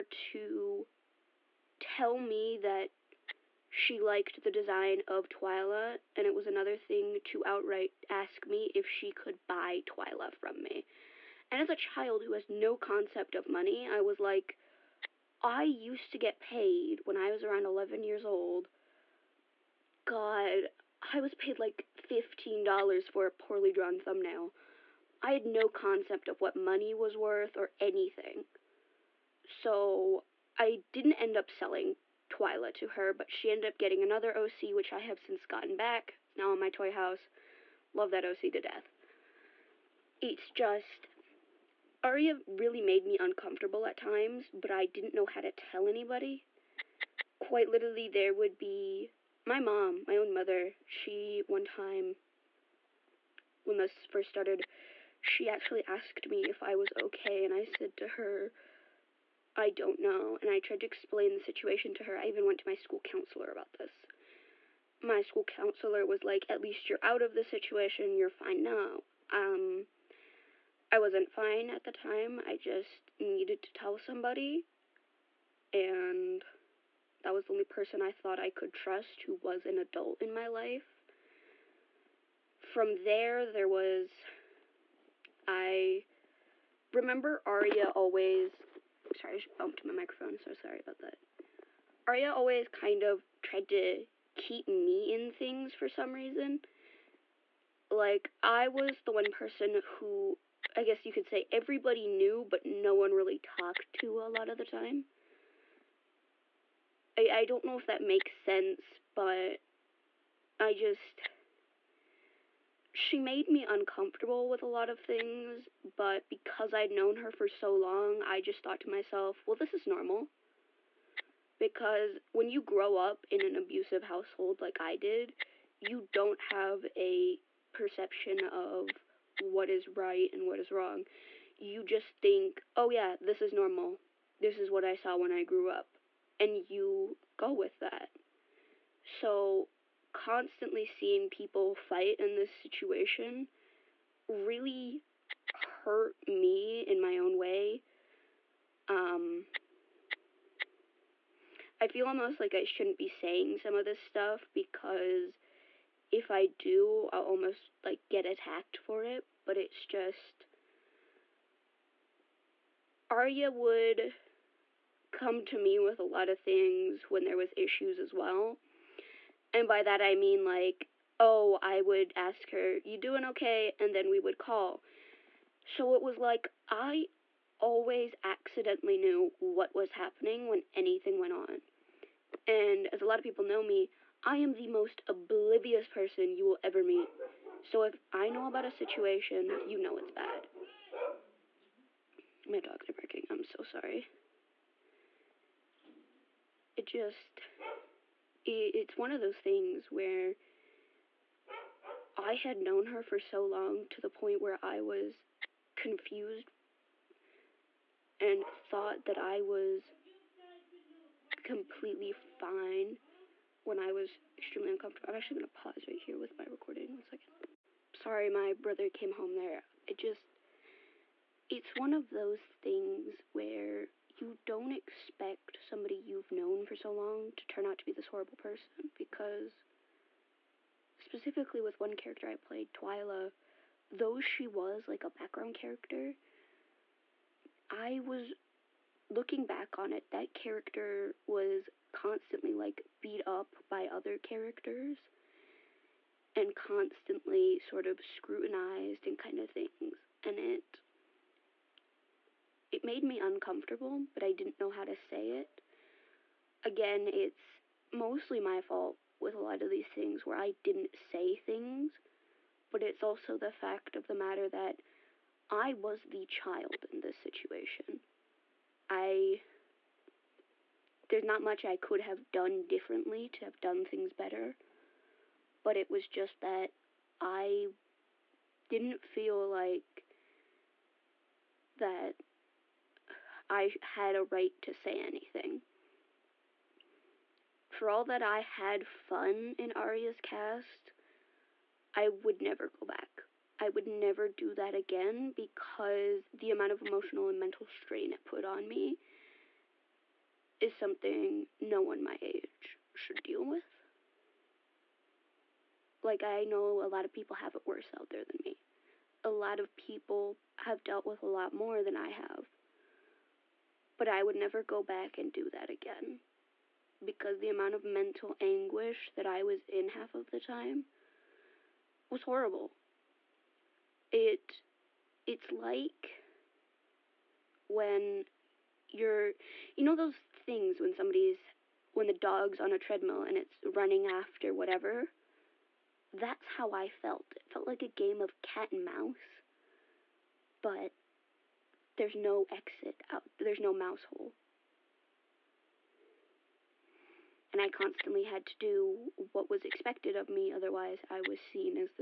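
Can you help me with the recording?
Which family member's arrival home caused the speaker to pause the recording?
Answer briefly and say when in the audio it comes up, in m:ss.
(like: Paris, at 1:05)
brother, at 3:38.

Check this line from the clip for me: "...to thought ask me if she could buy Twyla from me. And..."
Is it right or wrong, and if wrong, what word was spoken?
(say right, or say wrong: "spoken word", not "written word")
wrong: "outright", not "thought".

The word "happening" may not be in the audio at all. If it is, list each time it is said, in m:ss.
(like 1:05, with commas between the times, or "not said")
2:59.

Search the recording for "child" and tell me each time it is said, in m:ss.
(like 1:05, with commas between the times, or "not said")
0:11, 4:26.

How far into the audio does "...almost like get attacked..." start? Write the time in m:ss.
2:37.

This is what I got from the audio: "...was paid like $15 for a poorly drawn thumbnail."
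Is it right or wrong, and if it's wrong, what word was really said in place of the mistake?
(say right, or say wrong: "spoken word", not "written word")
right.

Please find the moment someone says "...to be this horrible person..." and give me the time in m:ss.
3:47.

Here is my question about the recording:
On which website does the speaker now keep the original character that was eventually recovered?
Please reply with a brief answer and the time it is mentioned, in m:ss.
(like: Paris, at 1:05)
Toyhouse, at 0:36.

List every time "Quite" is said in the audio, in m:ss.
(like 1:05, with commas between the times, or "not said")
0:47.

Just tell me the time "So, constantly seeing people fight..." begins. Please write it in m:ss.
2:19.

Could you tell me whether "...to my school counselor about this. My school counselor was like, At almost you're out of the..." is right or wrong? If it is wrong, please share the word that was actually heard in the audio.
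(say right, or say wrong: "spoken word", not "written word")
wrong: "least", not "almost".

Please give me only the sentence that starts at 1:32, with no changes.
Arya always kind of tried to keep me in things for some reason.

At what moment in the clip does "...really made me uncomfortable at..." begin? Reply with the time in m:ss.
0:42.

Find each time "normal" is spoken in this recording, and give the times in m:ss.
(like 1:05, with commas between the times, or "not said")
1:59, 2:13.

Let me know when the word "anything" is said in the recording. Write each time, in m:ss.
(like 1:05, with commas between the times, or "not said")
0:27, 3:00, 4:44.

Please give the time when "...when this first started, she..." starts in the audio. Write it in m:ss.
0:53.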